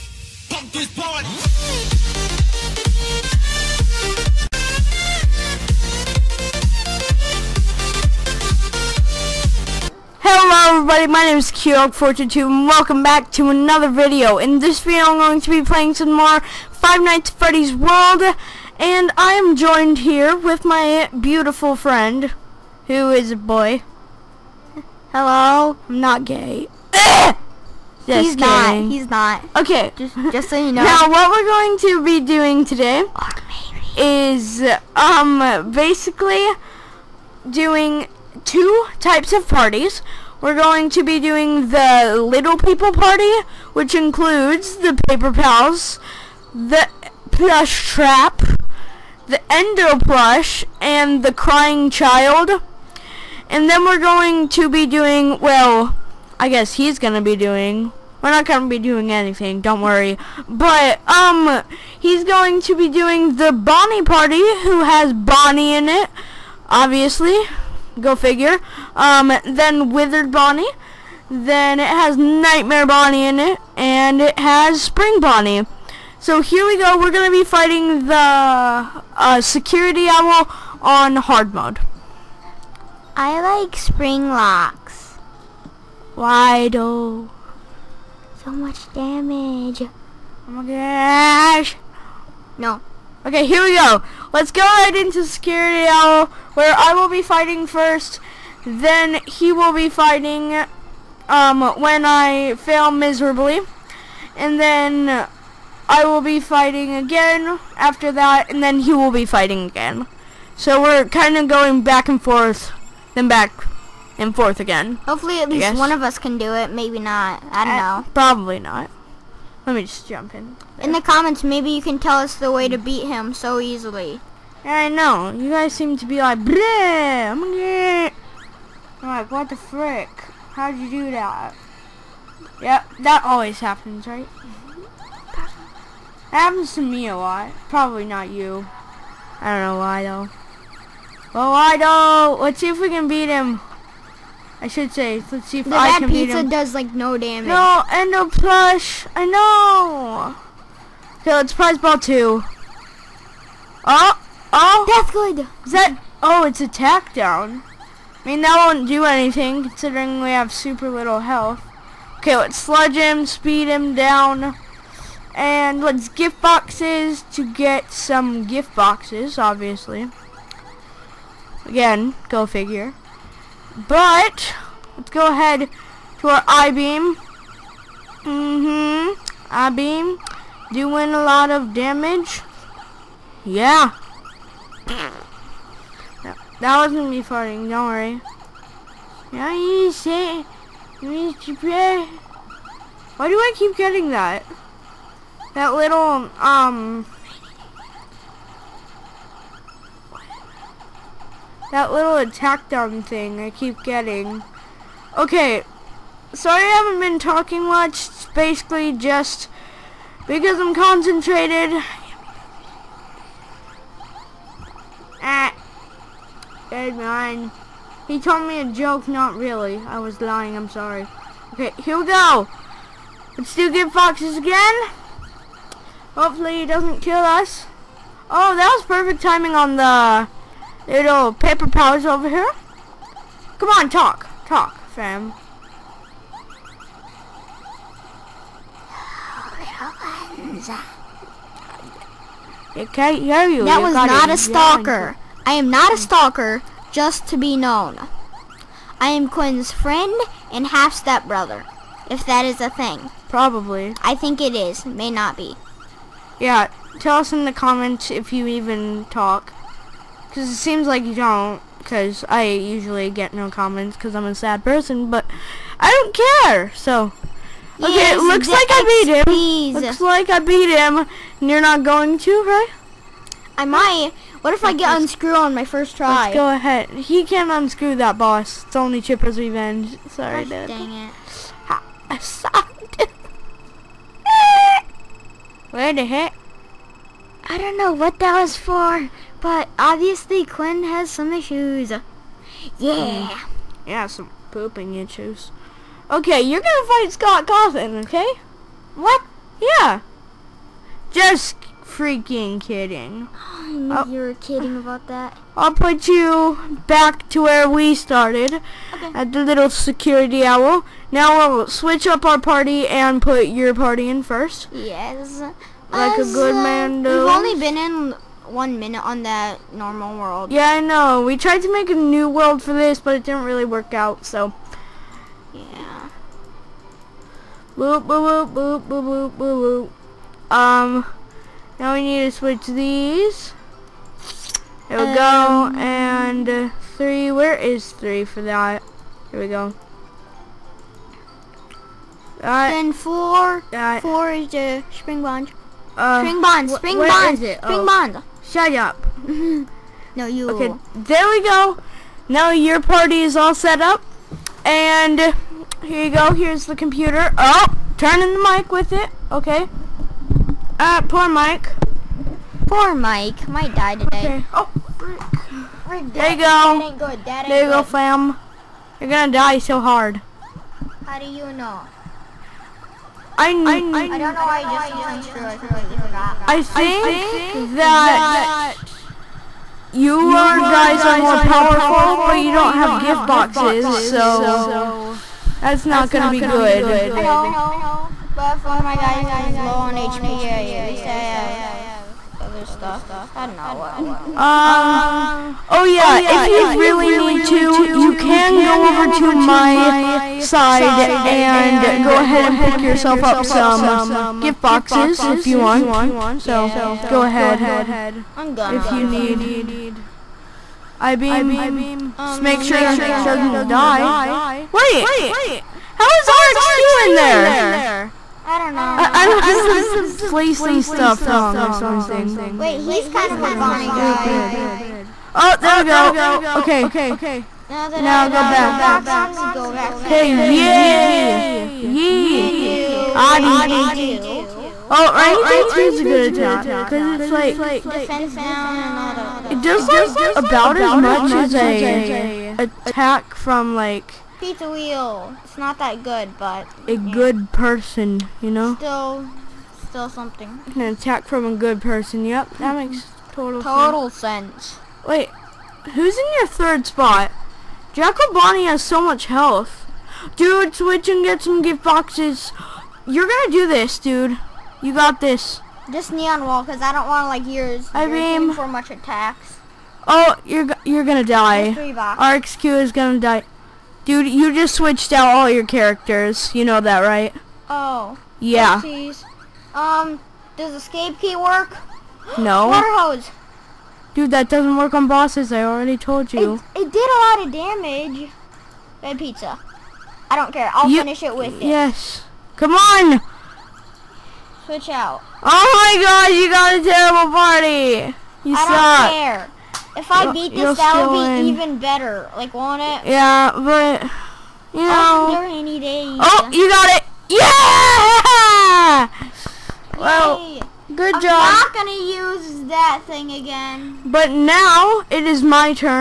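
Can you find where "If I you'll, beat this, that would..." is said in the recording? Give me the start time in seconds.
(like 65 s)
500 s.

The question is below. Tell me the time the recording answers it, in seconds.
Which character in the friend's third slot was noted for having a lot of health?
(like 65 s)
457 s.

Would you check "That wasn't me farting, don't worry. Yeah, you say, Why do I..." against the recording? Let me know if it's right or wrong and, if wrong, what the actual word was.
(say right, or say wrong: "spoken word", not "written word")
right.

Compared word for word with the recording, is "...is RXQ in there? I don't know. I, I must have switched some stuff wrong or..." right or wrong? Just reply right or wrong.
wrong.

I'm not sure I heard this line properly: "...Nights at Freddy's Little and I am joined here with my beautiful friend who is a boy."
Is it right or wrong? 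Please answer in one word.
wrong.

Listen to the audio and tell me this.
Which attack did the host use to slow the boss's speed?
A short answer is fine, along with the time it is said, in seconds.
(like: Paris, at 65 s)
Sludge, at 162 s.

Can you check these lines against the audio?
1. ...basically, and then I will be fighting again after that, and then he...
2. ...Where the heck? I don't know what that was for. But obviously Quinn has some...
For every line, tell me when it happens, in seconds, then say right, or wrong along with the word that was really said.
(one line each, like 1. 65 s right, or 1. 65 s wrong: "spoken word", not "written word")
1. 102 s wrong: "miserably", not "basically"
2. 285 s right.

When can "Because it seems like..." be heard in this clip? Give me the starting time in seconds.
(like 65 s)
260 s.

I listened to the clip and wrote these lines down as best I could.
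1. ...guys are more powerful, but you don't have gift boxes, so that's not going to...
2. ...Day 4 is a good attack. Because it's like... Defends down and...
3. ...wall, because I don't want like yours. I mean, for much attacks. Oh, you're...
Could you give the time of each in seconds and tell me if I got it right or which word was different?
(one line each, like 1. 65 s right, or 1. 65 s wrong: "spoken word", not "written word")
1. 380 s right
2. 435 s wrong: "2", not "4"
3. 466 s right.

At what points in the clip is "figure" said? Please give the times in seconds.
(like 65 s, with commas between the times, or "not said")
68 s, 172 s.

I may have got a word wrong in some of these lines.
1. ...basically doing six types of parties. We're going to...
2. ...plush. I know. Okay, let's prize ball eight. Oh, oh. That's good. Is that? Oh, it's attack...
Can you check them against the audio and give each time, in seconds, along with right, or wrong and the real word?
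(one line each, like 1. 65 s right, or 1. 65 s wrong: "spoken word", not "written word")
1. 35 s wrong: "two", not "six"
2. 148 s wrong: "two", not "eight".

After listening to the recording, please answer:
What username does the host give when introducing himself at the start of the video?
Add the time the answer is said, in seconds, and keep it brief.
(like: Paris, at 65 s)
QDog422, at 11 s.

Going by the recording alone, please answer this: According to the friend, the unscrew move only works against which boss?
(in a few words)
Chipper's Revenge.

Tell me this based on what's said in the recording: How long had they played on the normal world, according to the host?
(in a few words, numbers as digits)
1 minute.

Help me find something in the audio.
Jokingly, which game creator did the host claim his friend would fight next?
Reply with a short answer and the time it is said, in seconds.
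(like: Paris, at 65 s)
Scott Cawthon, at 297 s.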